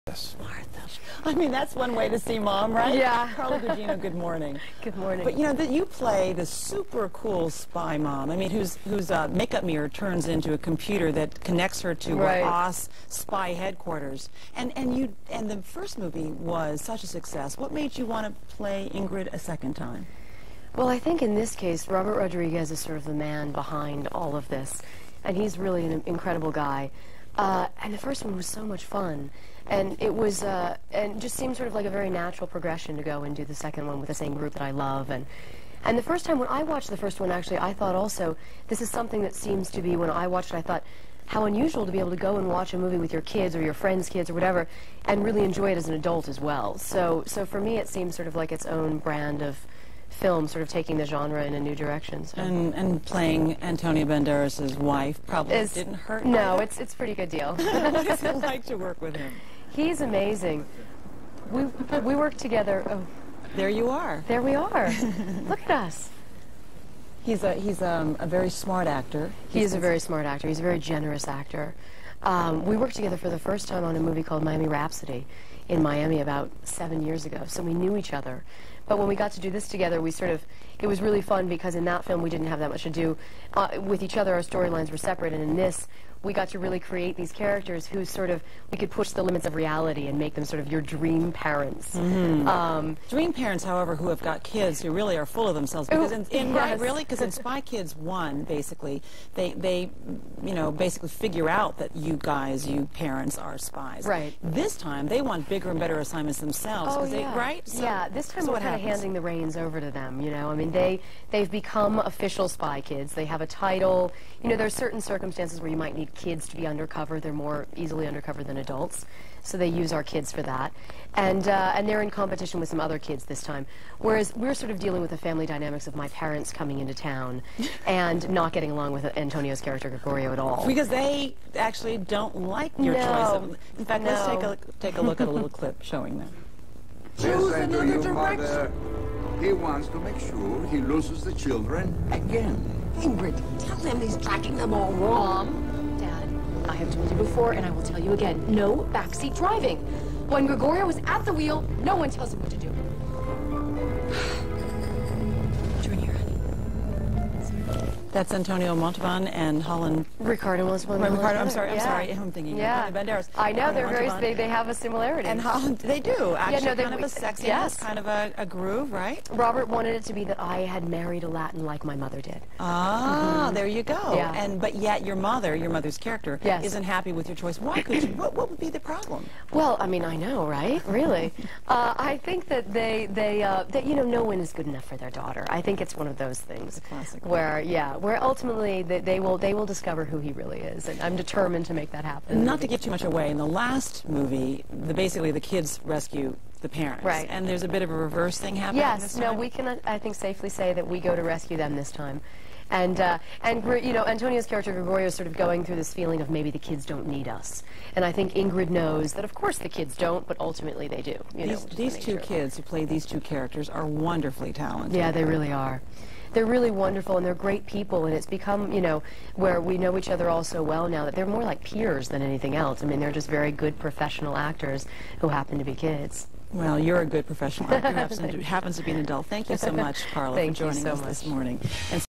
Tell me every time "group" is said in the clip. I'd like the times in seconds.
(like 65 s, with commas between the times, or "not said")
34 s.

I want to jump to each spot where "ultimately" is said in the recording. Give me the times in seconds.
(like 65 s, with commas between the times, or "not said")
188 s, 210 s.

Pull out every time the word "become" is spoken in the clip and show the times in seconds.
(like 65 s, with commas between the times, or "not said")
111 s, 218 s.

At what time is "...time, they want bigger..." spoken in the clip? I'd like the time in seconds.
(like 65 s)
104 s.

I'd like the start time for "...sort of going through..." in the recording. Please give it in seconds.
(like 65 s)
205 s.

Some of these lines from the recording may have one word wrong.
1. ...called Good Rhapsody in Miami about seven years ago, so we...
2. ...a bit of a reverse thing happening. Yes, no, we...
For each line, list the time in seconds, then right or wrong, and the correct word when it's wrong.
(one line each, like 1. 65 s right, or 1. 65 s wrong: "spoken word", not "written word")
1. 74 s wrong: "Miami", not "Good"
2. 197 s right.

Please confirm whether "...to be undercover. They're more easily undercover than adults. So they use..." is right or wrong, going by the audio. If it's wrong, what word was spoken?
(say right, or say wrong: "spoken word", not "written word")
right.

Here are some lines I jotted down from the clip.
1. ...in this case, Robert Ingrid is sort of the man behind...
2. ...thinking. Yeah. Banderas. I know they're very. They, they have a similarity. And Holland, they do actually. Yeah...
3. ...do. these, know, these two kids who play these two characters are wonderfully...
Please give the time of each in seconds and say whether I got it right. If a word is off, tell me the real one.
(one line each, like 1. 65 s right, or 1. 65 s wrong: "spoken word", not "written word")
1. 21 s wrong: "Rodriguez", not "Ingrid"
2. 162 s right
3. 211 s right.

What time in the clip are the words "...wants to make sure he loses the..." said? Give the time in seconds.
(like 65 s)
139 s.